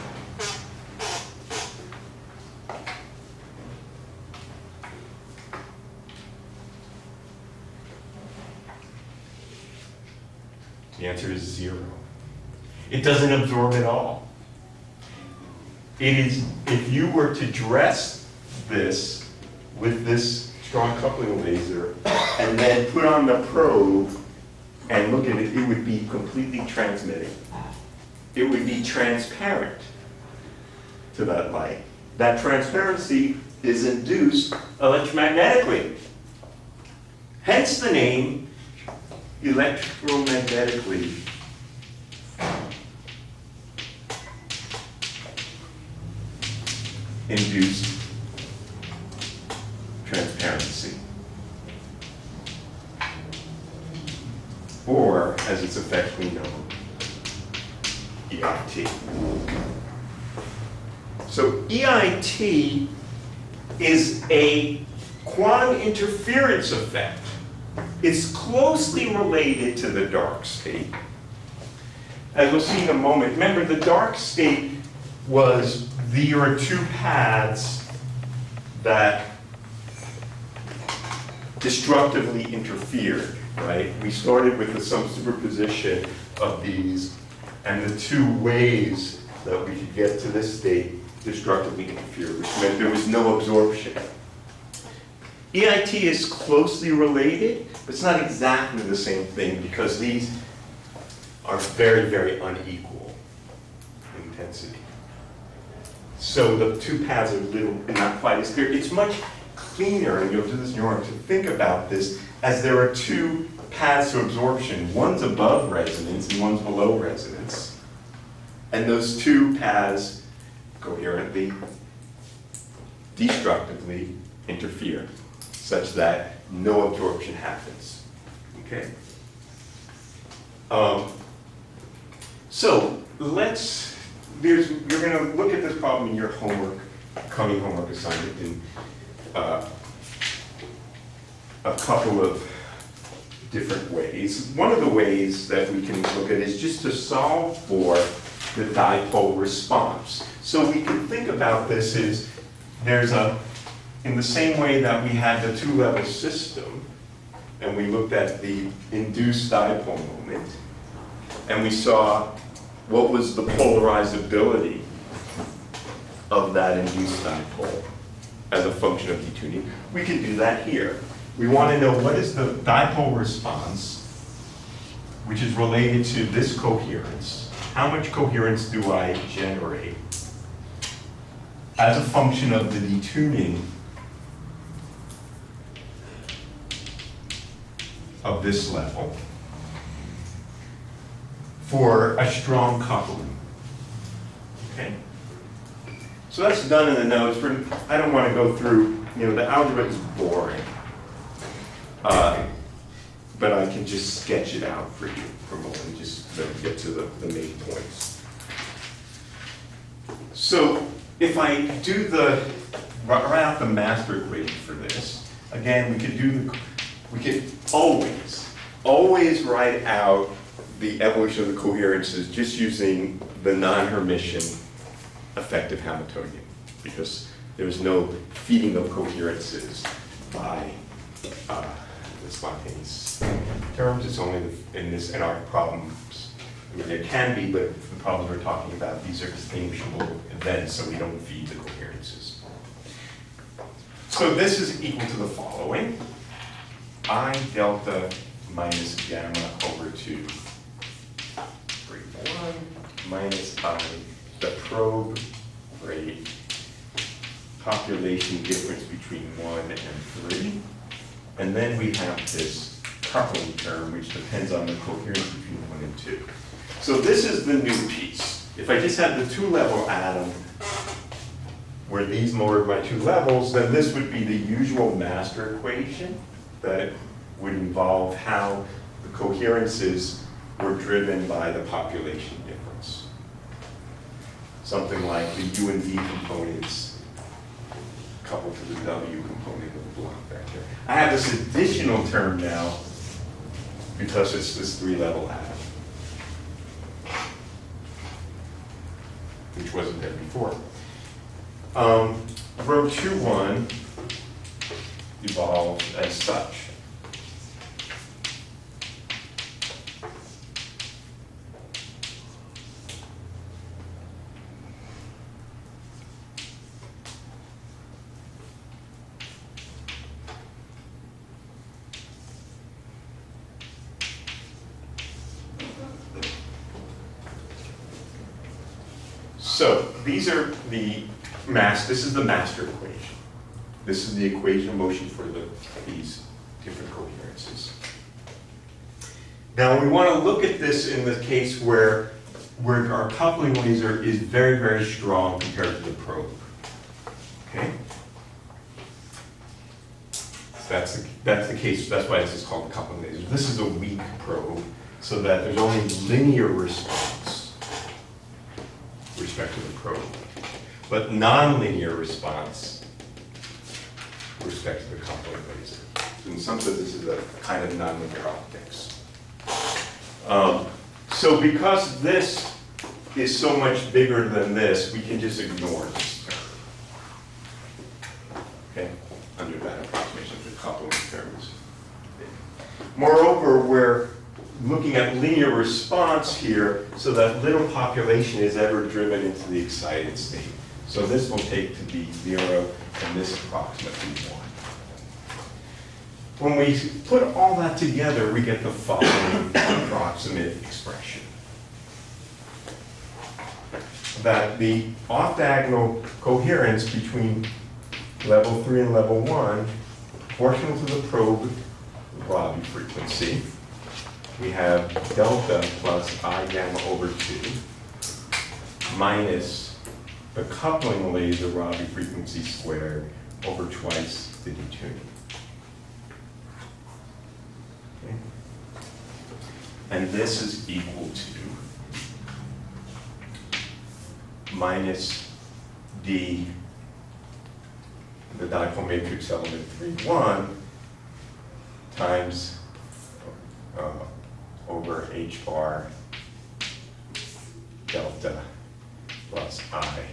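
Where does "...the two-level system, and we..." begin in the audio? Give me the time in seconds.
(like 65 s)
155 s.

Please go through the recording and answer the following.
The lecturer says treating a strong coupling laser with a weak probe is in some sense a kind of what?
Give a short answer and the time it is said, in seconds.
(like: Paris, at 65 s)
nonlinear optics, at 367 s.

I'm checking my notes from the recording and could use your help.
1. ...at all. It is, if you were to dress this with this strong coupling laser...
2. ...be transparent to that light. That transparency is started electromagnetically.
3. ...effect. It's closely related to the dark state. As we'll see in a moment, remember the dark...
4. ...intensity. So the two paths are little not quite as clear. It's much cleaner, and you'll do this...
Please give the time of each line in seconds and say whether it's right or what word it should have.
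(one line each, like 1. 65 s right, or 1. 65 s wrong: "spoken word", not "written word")
1. 13 s right
2. 28 s wrong: "induced", not "started"
3. 66 s right
4. 104 s right.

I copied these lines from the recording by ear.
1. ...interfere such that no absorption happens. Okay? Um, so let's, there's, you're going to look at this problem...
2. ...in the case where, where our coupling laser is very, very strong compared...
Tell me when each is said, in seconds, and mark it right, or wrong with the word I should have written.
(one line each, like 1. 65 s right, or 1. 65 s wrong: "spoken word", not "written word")
1. 124 s right
2. 340 s right.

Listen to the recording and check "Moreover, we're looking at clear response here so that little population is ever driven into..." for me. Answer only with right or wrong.
wrong.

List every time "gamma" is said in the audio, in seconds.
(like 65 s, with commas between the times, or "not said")
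249 s, 416 s.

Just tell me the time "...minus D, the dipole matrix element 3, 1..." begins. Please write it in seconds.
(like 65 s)
434 s.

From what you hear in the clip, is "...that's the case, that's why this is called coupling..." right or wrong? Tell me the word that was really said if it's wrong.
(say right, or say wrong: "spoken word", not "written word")
right.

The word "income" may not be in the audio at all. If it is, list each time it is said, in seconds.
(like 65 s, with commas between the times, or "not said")
not said.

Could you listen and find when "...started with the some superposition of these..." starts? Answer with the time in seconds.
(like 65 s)
84 s.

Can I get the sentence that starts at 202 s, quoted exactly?
Uh, but I can just sketch it out for you for a moment, just to get to the, the main points.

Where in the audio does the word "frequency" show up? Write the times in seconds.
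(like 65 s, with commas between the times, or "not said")
412 s, 421 s.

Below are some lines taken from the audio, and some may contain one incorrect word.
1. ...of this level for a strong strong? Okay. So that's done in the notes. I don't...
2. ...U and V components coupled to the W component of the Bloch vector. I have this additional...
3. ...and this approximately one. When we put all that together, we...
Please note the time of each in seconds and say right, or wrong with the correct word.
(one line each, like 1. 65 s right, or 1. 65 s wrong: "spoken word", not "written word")
1. 188 s wrong: "coupling", not "strong"
2. 285 s right
3. 393 s right.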